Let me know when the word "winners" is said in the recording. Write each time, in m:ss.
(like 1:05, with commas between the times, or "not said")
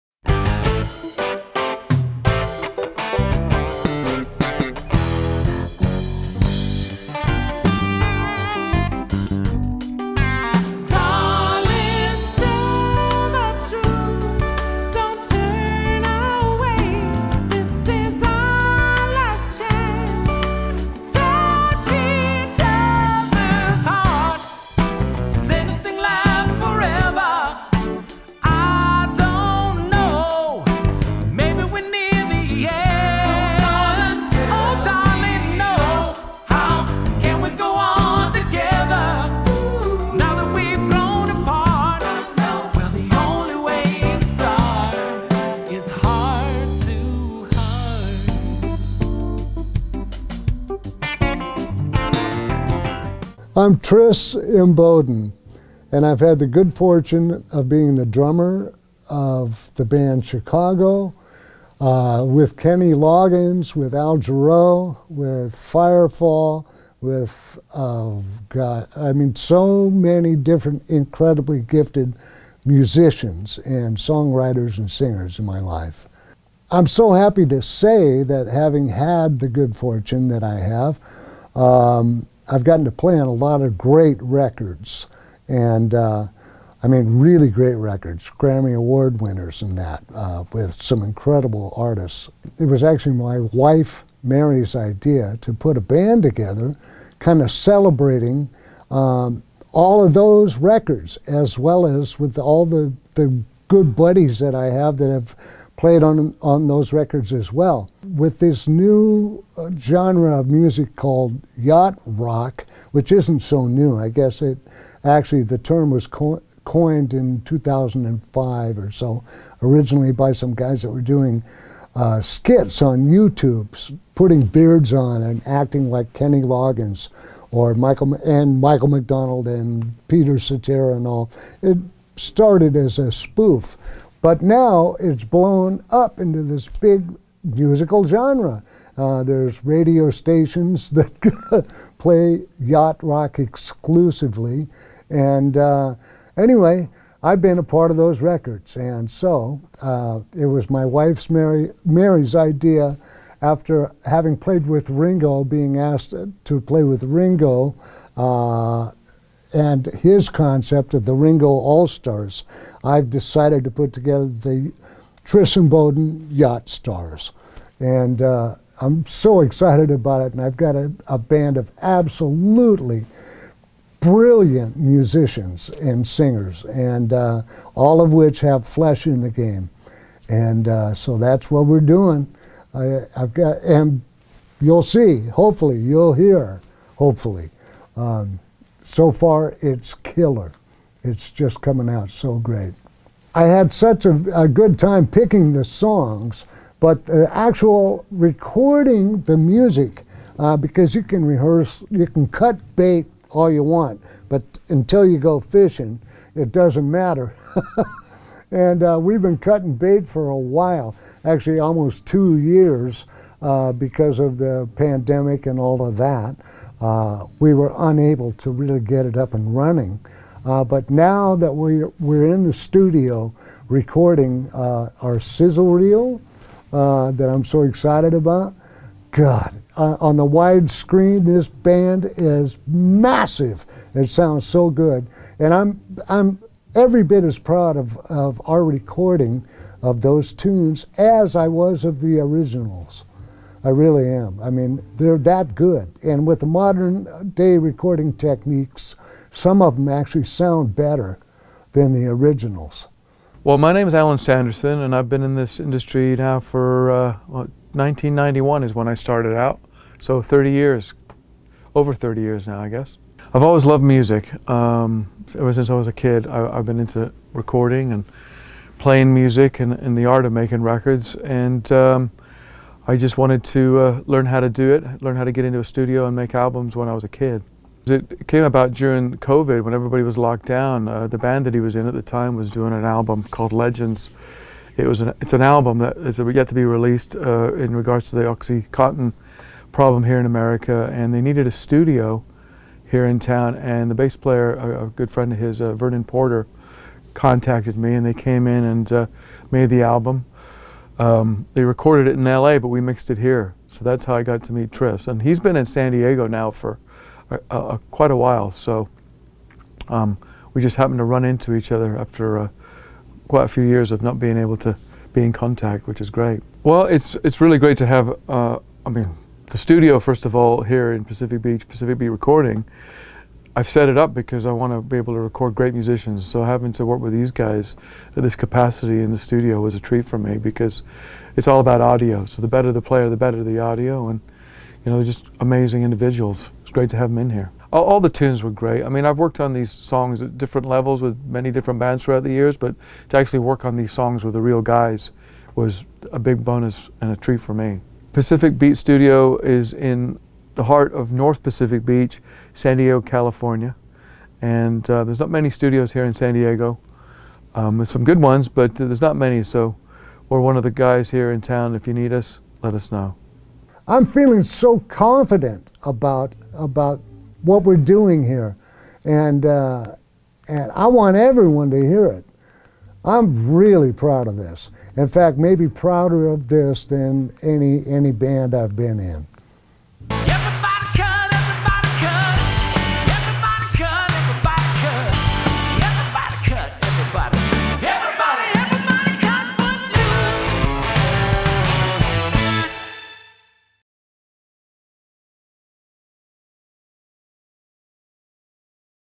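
1:29.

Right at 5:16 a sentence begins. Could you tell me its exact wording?
Well, it's it's really great to have.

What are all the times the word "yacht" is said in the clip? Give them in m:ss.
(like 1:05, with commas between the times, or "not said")
1:51, 2:22, 2:46.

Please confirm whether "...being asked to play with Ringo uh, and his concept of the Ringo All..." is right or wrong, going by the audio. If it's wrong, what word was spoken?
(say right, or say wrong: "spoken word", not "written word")
right.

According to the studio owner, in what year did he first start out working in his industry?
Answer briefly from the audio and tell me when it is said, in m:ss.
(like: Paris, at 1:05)
1991, at 4:17.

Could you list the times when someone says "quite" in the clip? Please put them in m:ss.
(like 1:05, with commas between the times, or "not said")
5:07, 5:13.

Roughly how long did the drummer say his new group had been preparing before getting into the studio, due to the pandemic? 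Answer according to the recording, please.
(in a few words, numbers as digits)
almost two years.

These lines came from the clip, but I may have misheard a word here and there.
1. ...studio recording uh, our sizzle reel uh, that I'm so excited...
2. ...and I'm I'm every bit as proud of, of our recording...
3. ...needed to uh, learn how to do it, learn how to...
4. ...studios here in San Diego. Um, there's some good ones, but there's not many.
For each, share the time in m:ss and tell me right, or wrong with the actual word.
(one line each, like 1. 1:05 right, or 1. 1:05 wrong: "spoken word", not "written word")
1. 3:42 right
2. 3:55 right
3. 4:33 wrong: "wanted", not "needed"
4. 5:55 right.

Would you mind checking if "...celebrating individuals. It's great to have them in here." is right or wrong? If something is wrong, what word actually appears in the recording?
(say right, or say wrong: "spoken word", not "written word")
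wrong: "amazing", not "celebrating".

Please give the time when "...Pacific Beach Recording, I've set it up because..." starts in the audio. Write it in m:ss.
5:21.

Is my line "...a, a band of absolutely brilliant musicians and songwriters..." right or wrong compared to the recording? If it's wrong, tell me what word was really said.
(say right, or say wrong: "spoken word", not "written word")
wrong: "singers", not "songwriters".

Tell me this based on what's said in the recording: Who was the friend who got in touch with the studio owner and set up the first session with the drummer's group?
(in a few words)
Vernon Porter.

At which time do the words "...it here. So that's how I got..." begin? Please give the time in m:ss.
5:03.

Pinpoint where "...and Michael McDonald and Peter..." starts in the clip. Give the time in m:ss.
2:08.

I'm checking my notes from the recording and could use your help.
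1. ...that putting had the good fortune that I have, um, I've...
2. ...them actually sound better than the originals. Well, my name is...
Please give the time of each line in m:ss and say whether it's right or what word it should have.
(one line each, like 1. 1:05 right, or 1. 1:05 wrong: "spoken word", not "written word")
1. 1:18 wrong: "having", not "putting"
2. 4:09 right.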